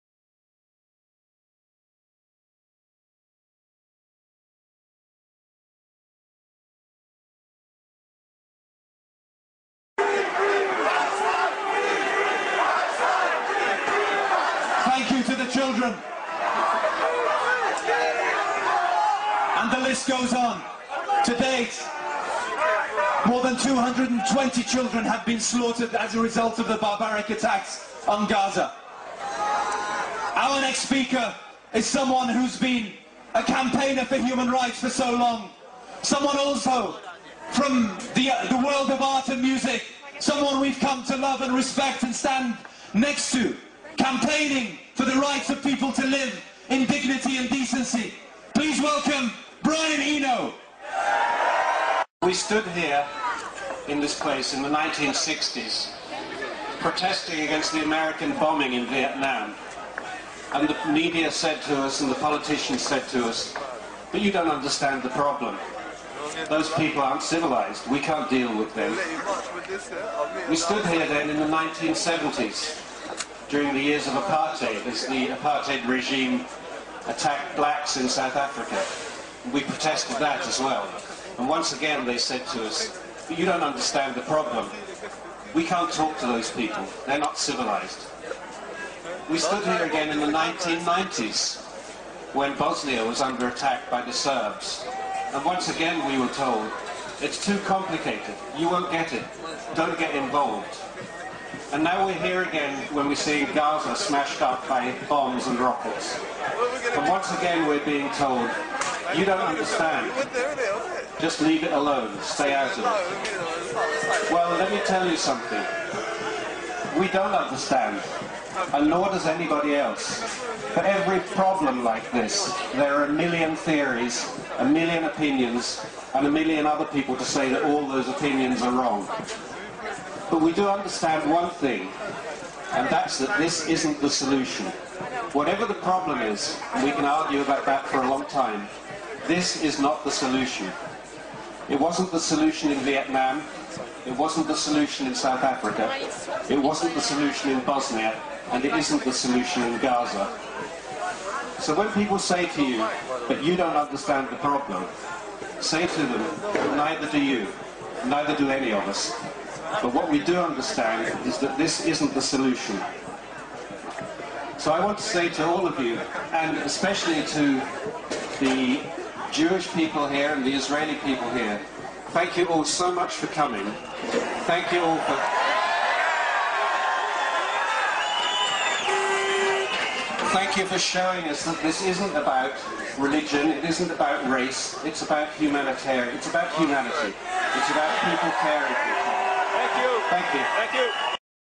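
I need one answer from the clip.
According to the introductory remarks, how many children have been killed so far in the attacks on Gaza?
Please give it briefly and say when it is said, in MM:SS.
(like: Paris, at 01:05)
more than 220, at 00:23.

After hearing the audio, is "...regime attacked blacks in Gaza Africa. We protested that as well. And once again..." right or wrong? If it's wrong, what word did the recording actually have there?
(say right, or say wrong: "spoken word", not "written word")
wrong: "South", not "Gaza".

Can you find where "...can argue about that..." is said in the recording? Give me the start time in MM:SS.
02:16.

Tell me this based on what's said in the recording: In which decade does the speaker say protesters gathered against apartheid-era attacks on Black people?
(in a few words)
1970s.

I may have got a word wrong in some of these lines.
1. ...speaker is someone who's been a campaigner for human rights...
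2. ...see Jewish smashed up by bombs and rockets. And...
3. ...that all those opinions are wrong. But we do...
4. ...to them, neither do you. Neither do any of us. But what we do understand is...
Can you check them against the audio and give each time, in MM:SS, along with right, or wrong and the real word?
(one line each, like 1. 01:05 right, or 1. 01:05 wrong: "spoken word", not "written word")
1. 00:30 right
2. 01:43 wrong: "Gaza", not "Jewish"
3. 02:07 right
4. 02:35 right.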